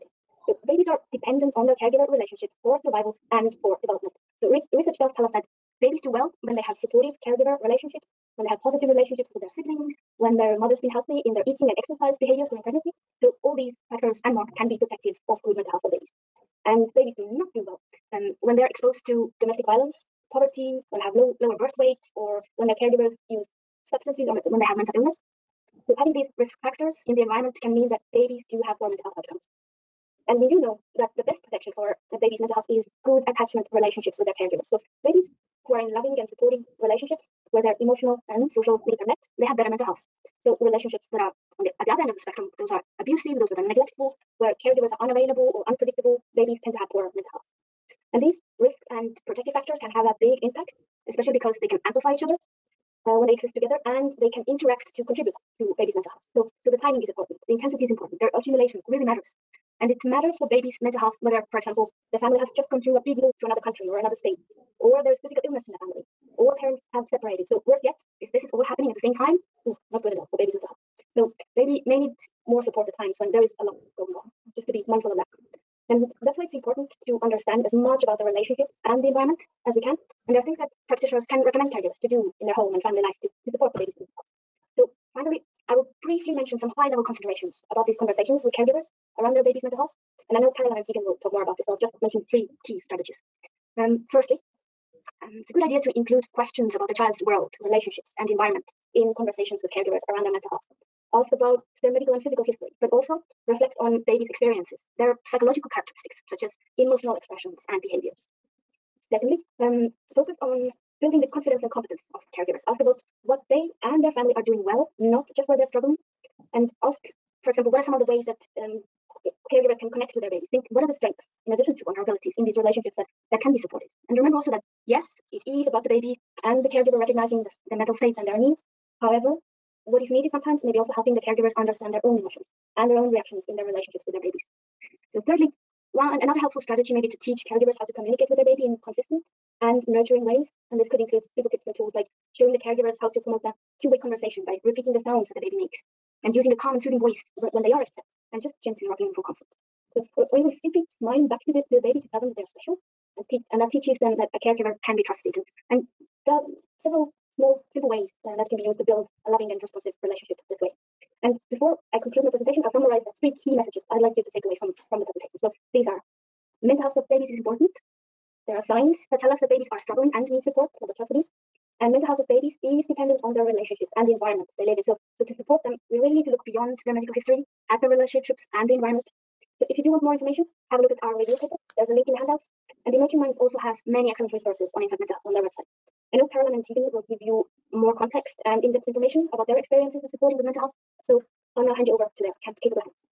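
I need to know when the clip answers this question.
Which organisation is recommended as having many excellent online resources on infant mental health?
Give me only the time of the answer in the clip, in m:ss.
3:02.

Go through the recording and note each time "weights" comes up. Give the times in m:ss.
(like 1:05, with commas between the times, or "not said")
0:21.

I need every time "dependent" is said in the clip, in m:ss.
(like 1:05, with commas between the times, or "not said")
0:01, 2:52.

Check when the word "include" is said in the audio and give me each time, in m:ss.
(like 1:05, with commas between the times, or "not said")
1:35, 2:20.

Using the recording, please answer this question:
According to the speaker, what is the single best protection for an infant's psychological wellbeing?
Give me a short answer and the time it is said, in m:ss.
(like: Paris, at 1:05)
good attachment relationships, at 0:33.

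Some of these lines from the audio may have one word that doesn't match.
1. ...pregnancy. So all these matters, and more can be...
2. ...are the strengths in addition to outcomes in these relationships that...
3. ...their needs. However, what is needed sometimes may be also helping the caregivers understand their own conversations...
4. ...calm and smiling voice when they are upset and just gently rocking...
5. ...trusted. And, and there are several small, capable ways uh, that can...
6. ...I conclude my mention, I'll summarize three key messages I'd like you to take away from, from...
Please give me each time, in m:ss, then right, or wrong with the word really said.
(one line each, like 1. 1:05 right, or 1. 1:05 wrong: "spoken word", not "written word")
1. 0:12 wrong: "factors", not "matters"
2. 2:00 wrong: "vulnerabilities", not "outcomes"
3. 2:08 wrong: "emotions", not "conversations"
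4. 2:26 wrong: "soothing", not "smiling"
5. 2:35 wrong: "simple", not "capable"
6. 2:41 wrong: "presentation", not "mention".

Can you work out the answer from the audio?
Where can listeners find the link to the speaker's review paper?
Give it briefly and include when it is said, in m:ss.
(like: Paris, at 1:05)
in the handouts, at 3:02.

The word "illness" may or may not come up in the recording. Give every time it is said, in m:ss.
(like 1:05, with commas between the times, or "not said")
0:24, 1:05.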